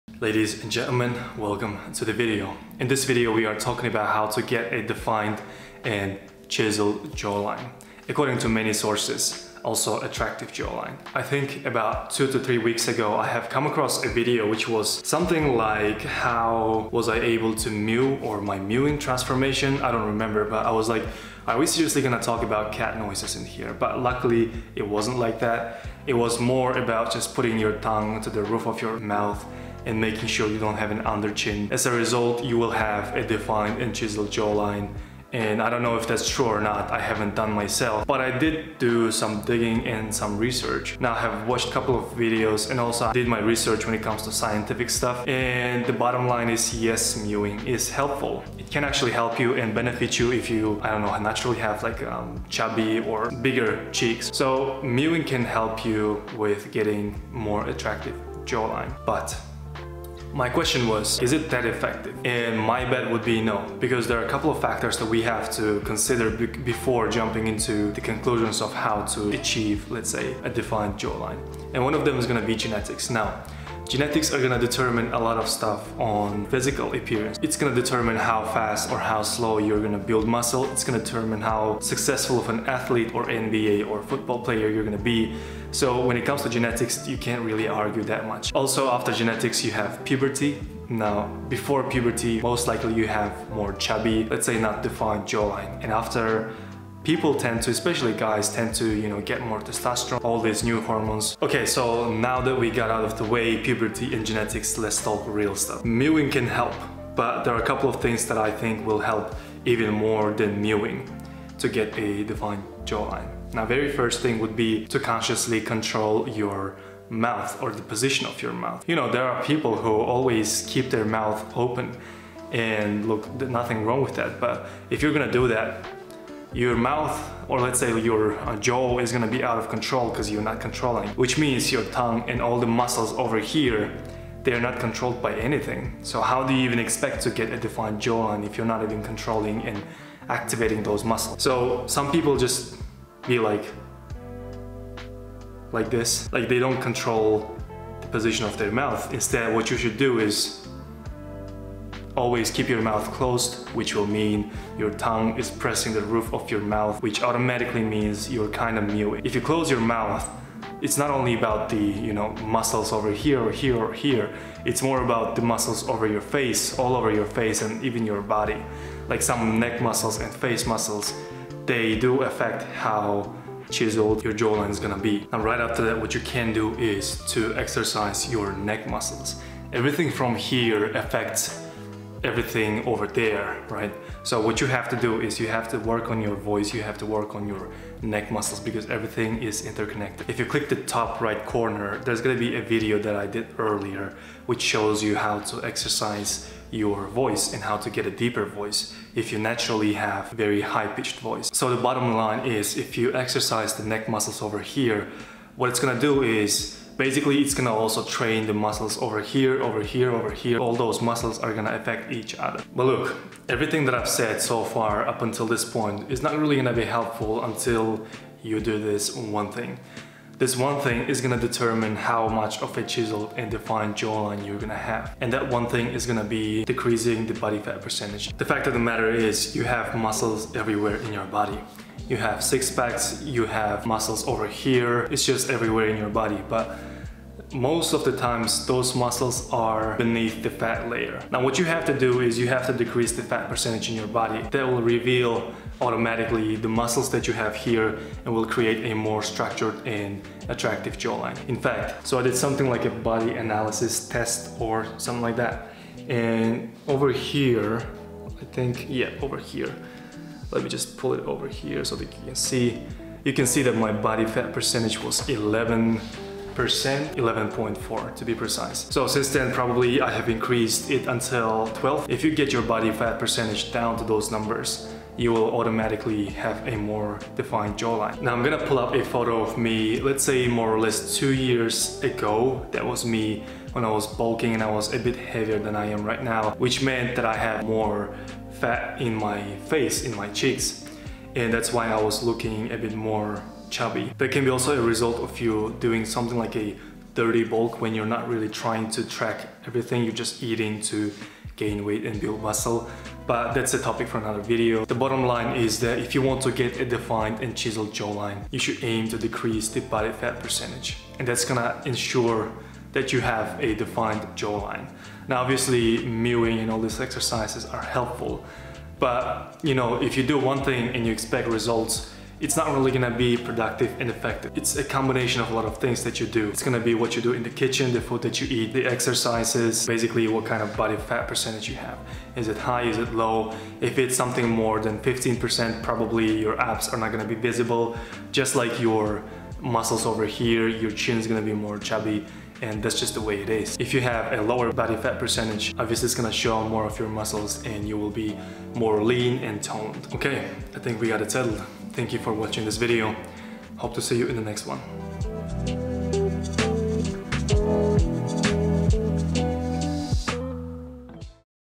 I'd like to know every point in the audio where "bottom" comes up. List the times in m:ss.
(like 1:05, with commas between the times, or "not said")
0:45, 3:21, 5:05.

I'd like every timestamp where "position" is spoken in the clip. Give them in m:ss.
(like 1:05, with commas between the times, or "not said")
1:57, 2:28.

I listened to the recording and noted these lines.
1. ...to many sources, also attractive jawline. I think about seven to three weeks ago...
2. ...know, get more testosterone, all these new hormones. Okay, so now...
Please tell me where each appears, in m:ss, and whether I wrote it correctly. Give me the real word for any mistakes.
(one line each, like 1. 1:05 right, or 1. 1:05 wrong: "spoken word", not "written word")
1. 0:08 wrong: "two", not "seven"
2. 1:39 right.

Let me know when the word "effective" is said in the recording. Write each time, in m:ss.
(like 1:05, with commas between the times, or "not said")
1:01, 5:24.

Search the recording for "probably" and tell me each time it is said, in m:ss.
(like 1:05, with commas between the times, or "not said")
4:29, 5:35.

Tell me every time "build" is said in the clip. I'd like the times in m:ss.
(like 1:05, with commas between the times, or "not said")
1:19, 5:02.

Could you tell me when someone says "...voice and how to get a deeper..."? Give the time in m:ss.
3:17.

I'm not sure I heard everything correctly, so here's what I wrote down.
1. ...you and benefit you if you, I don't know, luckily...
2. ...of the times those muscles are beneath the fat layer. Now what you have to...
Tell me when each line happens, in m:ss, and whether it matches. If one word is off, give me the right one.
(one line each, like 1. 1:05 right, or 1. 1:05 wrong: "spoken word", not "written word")
1. 0:49 wrong: "naturally", not "luckily"
2. 3:57 right.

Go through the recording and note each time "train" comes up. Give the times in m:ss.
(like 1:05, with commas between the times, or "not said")
3:28.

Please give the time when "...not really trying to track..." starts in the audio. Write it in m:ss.
4:58.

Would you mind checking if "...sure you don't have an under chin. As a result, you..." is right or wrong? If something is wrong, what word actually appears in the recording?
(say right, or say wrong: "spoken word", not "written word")
right.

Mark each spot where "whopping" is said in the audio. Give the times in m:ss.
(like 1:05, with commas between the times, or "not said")
not said.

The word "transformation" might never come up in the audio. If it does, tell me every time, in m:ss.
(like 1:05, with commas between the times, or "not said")
0:18.